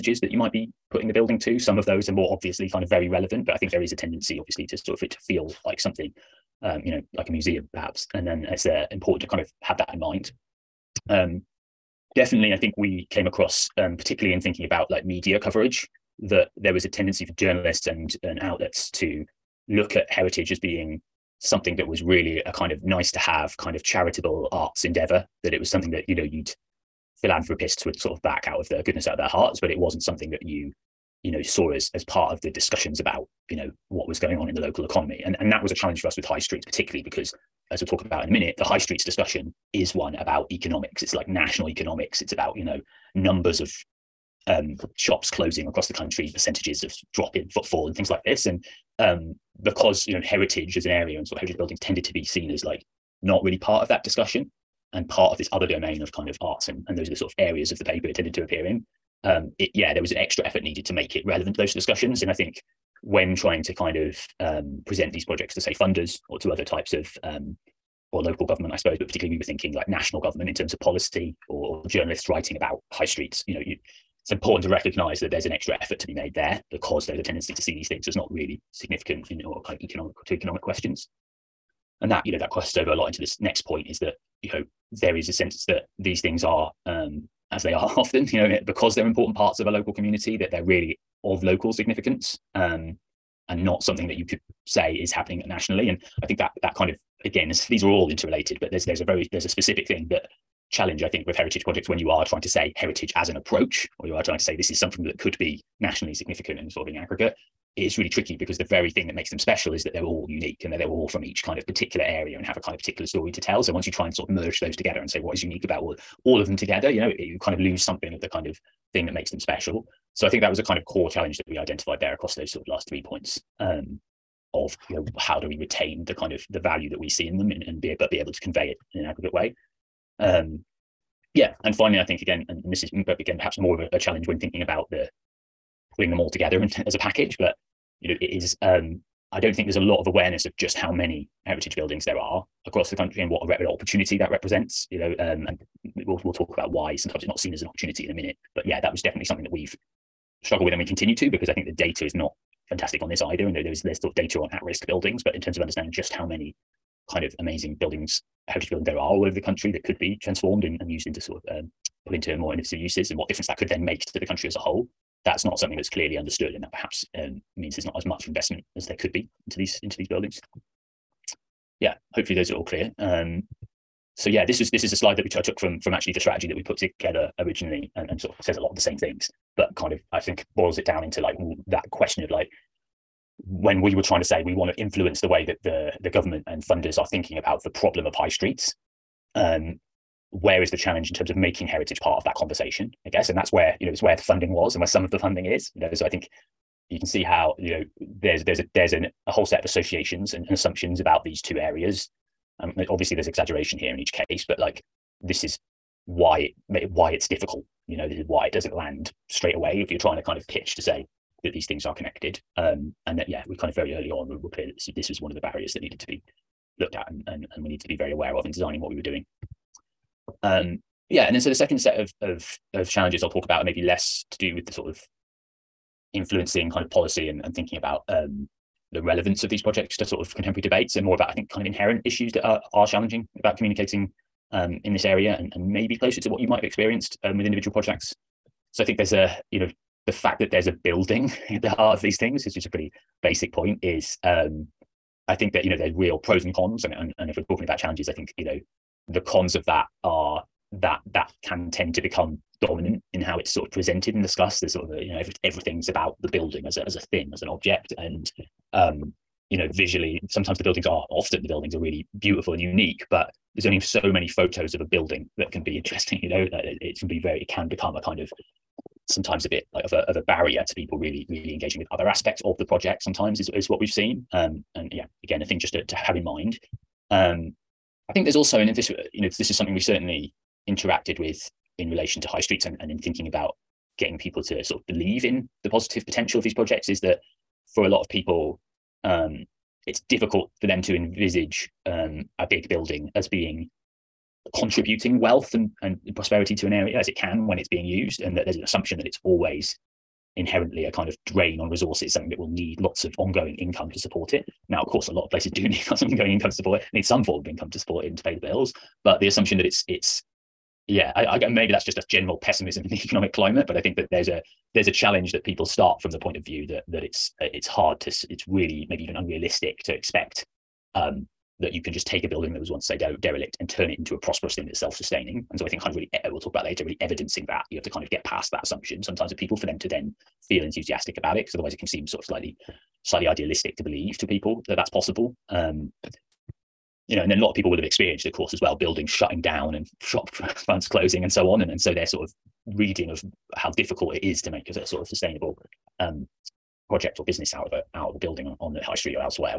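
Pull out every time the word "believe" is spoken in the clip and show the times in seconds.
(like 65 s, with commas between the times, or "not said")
284 s, 333 s.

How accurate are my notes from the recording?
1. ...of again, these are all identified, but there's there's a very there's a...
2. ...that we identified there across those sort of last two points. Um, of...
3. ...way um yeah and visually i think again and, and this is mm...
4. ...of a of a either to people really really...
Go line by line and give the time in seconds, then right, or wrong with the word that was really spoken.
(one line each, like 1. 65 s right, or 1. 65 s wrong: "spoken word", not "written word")
1. 96 s wrong: "interrelated", not "identified"
2. 121 s wrong: "three", not "two"
3. 129 s wrong: "finally", not "visually"
4. 269 s wrong: "barrier", not "either".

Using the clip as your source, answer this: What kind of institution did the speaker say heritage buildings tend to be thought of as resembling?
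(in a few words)
a museum.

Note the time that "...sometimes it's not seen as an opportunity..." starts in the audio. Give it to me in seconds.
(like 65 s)
146 s.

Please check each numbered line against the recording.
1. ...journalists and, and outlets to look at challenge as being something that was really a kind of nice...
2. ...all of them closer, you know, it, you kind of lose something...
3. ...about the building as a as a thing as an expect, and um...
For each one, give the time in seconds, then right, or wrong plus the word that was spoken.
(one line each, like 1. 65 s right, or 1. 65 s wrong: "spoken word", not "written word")
1. 17 s wrong: "heritage", not "challenge"
2. 116 s wrong: "together", not "closer"
3. 255 s wrong: "object", not "expect".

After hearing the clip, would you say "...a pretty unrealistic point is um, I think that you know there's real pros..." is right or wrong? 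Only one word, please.
wrong.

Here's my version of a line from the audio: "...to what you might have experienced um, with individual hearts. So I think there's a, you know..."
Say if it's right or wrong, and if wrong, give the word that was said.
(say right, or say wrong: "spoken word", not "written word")
wrong: "projects", not "hearts".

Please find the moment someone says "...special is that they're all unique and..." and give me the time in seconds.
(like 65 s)
109 s.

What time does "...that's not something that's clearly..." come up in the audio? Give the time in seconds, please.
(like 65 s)
165 s.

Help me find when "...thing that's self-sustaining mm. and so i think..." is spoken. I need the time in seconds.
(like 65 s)
324 s.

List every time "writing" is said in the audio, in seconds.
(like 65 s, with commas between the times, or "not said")
72 s.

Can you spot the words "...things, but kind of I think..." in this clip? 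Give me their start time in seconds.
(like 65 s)
178 s.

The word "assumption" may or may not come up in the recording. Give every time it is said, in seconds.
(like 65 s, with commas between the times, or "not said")
200 s, 298 s, 309 s, 328 s.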